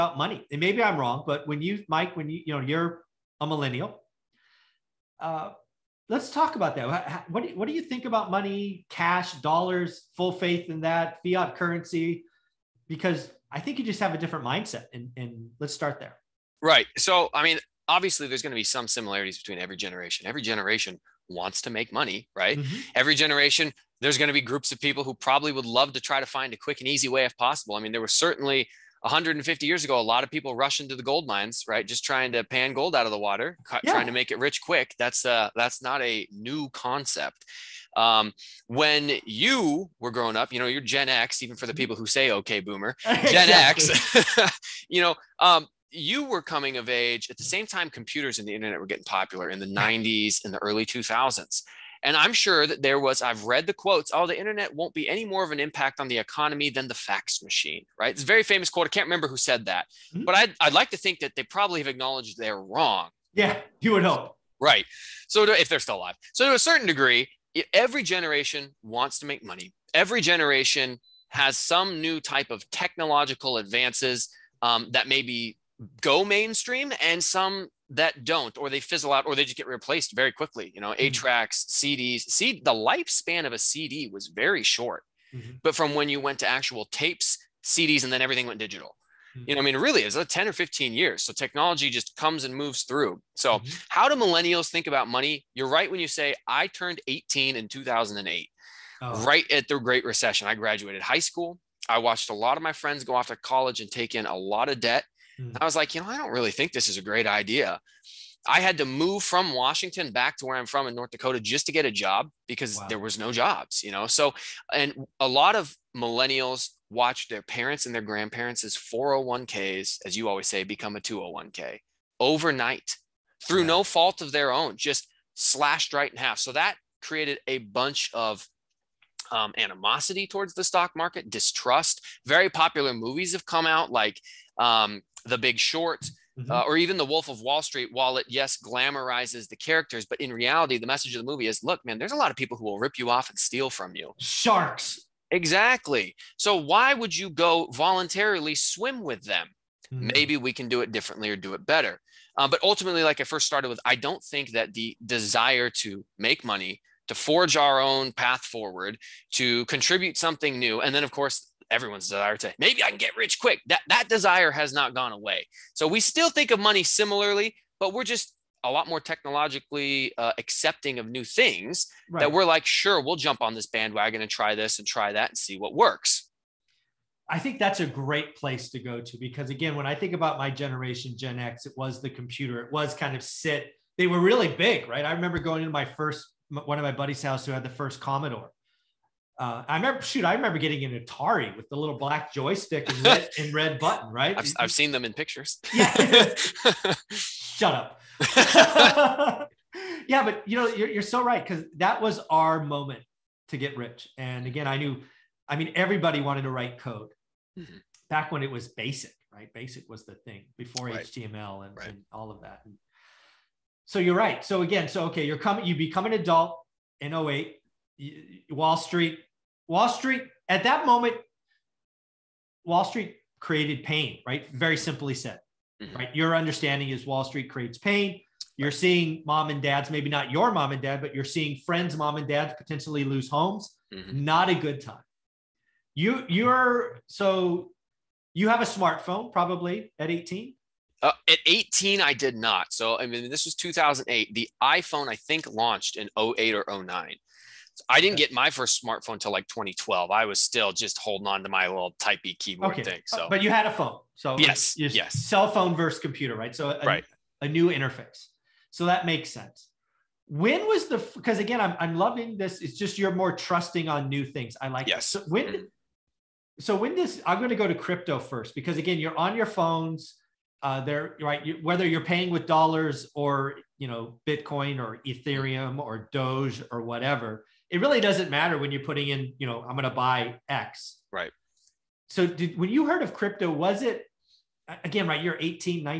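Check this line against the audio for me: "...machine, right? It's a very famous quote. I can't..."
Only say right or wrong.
right.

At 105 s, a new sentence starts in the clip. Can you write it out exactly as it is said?
I was like, you know, I don't really think this is a great idea.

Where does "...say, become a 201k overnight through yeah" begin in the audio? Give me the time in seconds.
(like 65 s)
120 s.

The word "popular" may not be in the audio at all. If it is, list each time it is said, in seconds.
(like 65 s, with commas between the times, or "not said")
49 s, 132 s.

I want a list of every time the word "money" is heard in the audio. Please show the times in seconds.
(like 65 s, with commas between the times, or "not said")
0 s, 8 s, 21 s, 69 s, 95 s, 156 s, 166 s.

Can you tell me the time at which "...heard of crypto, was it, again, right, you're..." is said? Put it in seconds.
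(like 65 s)
282 s.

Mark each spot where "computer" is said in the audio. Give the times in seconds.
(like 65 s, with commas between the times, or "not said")
47 s, 182 s, 255 s.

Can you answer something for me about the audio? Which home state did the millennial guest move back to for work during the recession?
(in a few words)
North Dakota.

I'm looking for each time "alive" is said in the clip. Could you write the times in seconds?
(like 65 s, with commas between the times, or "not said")
65 s.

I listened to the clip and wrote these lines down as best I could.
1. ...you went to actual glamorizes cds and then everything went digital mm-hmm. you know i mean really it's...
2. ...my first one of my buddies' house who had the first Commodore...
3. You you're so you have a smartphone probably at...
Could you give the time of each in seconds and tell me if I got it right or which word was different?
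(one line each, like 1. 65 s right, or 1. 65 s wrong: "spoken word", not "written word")
1. 86 s wrong: "tapes", not "glamorizes"
2. 185 s right
3. 235 s right.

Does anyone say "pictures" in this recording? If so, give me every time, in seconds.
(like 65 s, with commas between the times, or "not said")
195 s.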